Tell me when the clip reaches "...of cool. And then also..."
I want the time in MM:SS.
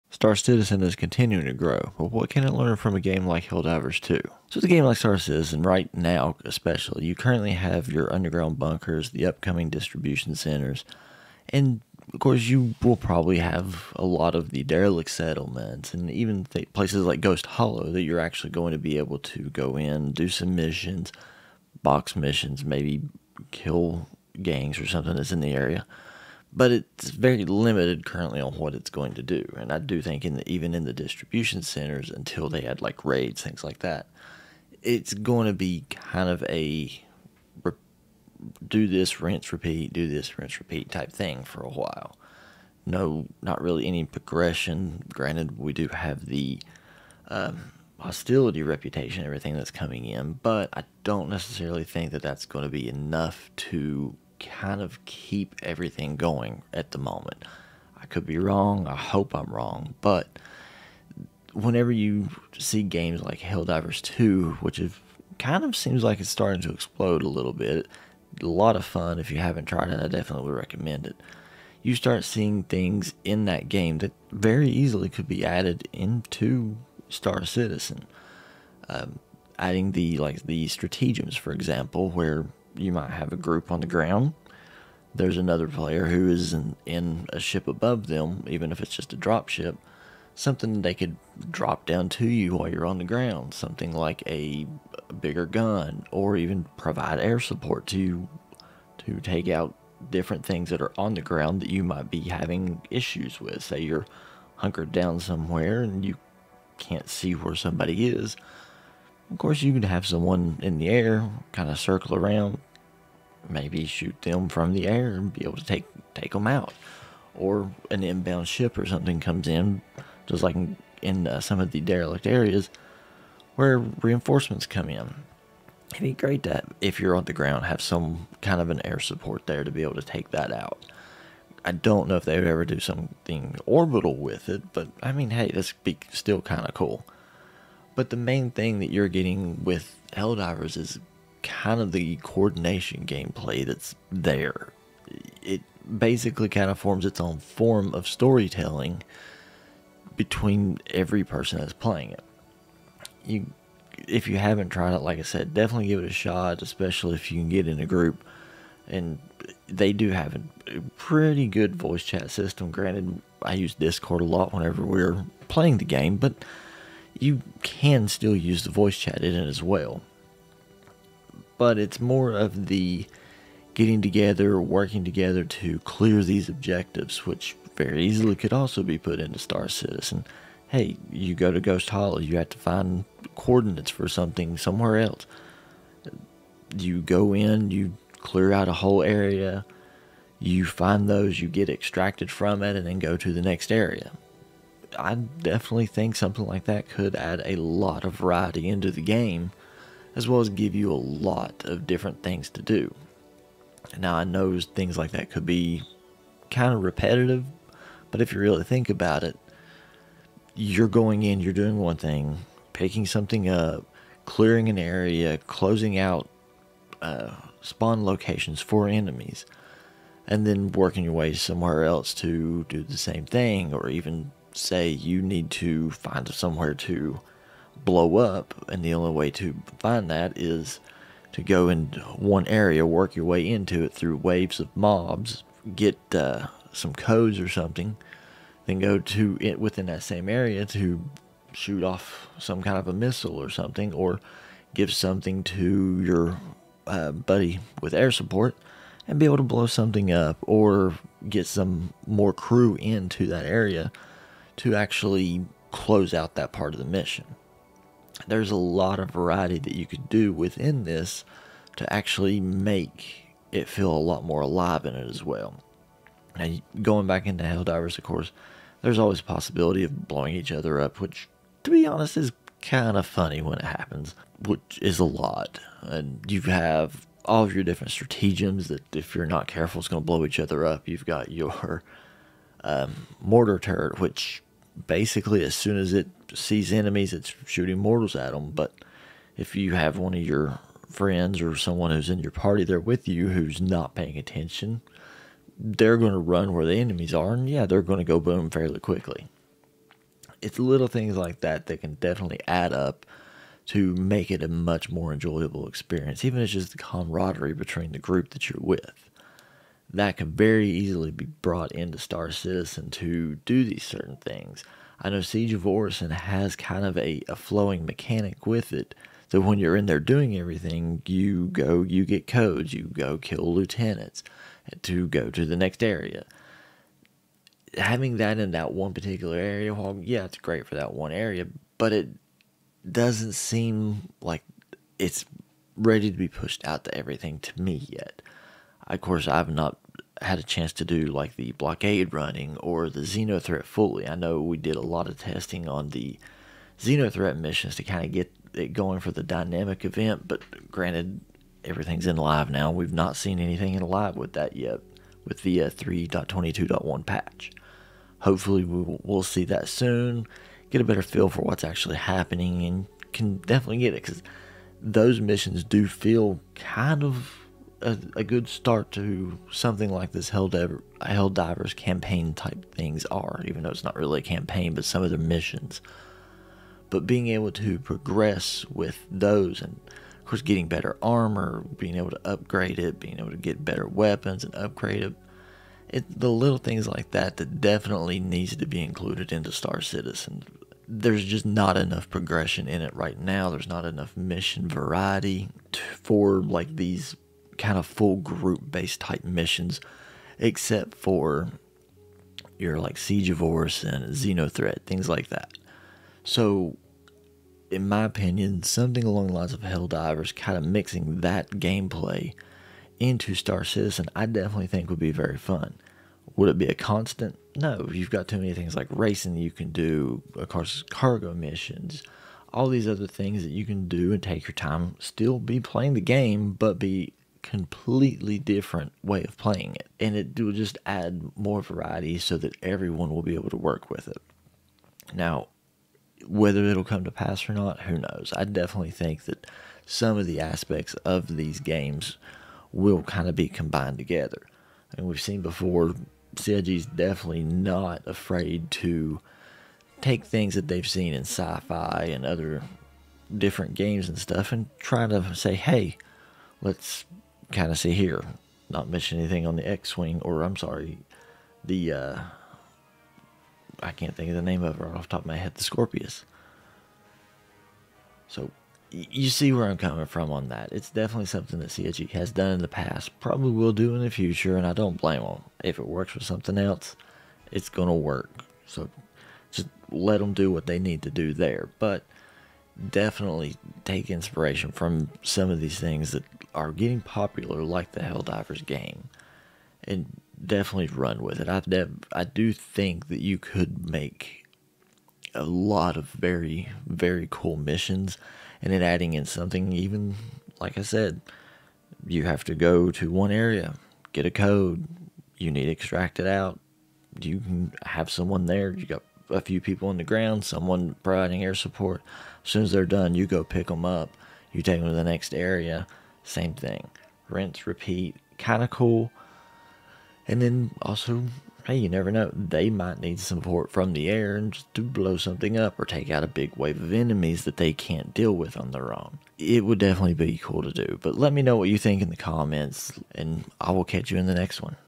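08:38.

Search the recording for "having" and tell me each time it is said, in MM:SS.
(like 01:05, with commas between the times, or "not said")
01:42, 05:27.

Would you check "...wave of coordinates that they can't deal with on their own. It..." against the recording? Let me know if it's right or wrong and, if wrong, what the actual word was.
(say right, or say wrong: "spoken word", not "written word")
wrong: "enemies", not "coordinates".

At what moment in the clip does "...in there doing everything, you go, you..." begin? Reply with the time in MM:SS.
05:19.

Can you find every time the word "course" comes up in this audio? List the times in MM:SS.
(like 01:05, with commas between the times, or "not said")
00:12, 01:49, 04:28, 05:38, 06:20, 07:00.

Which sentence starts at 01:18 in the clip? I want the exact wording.
Um, adding the like the stratagems, for example, where you might have a group on the ground.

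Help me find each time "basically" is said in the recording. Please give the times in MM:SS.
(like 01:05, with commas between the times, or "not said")
02:25, 04:44.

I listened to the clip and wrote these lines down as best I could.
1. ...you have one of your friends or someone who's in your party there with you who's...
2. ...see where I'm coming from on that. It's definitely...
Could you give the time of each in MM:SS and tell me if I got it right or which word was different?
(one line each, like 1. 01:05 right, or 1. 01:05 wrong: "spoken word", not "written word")
1. 04:49 right
2. 07:49 right.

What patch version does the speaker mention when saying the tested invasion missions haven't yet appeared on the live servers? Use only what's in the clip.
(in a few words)
3.22.1.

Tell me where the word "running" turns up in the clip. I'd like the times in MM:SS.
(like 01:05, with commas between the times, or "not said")
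05:42.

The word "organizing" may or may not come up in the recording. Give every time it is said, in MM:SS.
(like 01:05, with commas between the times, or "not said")
not said.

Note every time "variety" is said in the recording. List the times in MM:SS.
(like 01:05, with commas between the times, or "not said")
03:18, 04:19, 06:34, 07:11.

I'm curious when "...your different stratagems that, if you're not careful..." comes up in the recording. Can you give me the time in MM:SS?
04:37.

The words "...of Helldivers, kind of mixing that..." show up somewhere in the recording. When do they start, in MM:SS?
06:49.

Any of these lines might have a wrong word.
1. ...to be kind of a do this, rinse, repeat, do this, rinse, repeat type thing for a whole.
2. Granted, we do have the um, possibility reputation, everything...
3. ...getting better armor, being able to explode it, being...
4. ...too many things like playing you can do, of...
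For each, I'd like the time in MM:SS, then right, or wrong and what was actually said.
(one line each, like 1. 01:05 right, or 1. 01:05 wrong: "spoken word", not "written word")
1. 00:35 wrong: "while", not "whole"
2. 00:45 wrong: "hostility", not "possibility"
3. 06:20 wrong: "upgrade", not "explode"
4. 06:58 wrong: "racing", not "playing".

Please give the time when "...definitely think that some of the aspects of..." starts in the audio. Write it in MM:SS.
07:18.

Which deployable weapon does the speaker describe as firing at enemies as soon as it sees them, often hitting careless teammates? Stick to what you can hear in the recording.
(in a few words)
mortar turret.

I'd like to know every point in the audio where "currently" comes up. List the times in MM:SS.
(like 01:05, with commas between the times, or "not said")
00:07, 00:28.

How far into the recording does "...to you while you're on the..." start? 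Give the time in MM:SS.
01:32.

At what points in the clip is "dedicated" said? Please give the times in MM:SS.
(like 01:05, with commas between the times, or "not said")
not said.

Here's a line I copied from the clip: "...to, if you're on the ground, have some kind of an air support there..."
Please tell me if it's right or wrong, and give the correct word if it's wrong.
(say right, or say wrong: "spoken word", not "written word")
right.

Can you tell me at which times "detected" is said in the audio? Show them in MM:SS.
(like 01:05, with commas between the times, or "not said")
not said.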